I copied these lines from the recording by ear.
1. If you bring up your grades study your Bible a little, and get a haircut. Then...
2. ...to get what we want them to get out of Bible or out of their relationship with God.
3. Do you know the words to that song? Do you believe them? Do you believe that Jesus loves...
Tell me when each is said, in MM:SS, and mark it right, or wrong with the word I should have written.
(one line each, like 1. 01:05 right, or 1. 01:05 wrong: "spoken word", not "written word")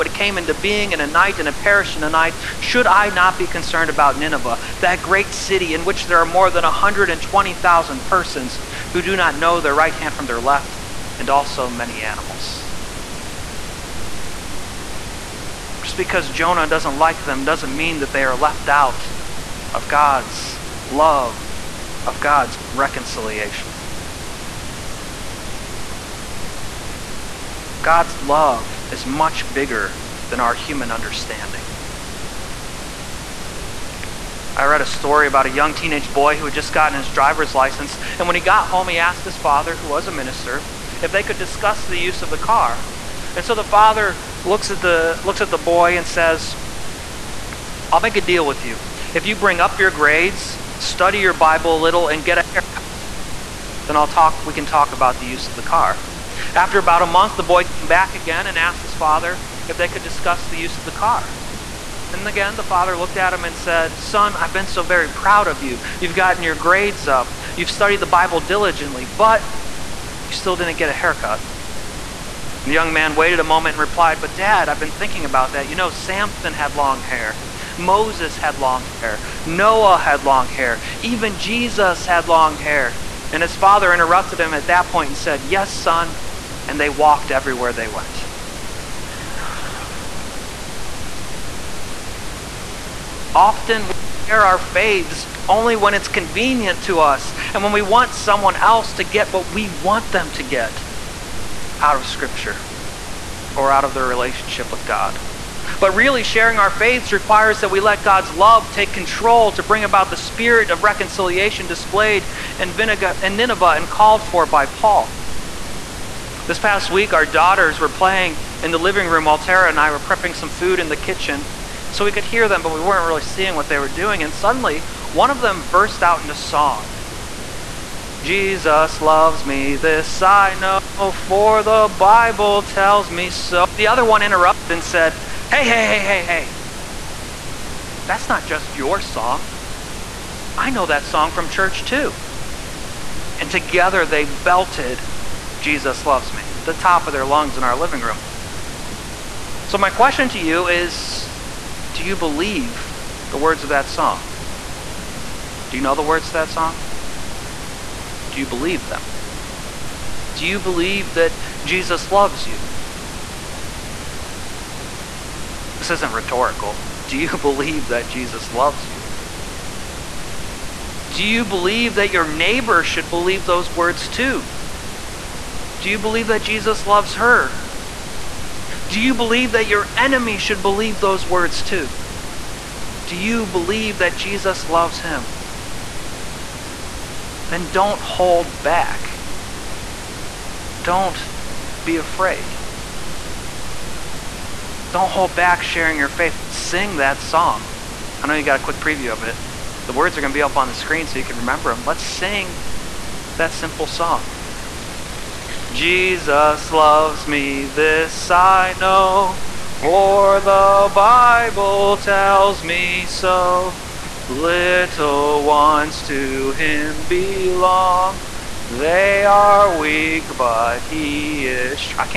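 1. 00:49 right
2. 01:38 wrong: "Scripture", not "Bible"
3. 02:35 right.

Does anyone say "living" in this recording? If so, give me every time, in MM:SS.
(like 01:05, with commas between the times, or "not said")
01:58, 02:27.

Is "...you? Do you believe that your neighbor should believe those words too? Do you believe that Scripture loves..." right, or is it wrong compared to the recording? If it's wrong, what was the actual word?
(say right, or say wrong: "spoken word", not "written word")
wrong: "Jesus", not "Scripture".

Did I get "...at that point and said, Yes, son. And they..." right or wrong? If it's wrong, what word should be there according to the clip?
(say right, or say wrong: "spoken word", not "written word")
right.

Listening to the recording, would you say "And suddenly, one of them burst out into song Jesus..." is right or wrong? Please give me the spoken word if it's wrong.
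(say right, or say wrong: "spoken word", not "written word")
right.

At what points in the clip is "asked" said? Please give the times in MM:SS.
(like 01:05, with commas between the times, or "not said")
00:38, 00:58.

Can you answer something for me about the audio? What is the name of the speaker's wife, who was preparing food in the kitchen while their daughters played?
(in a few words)
Tara.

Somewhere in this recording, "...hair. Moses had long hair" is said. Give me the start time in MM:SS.
01:17.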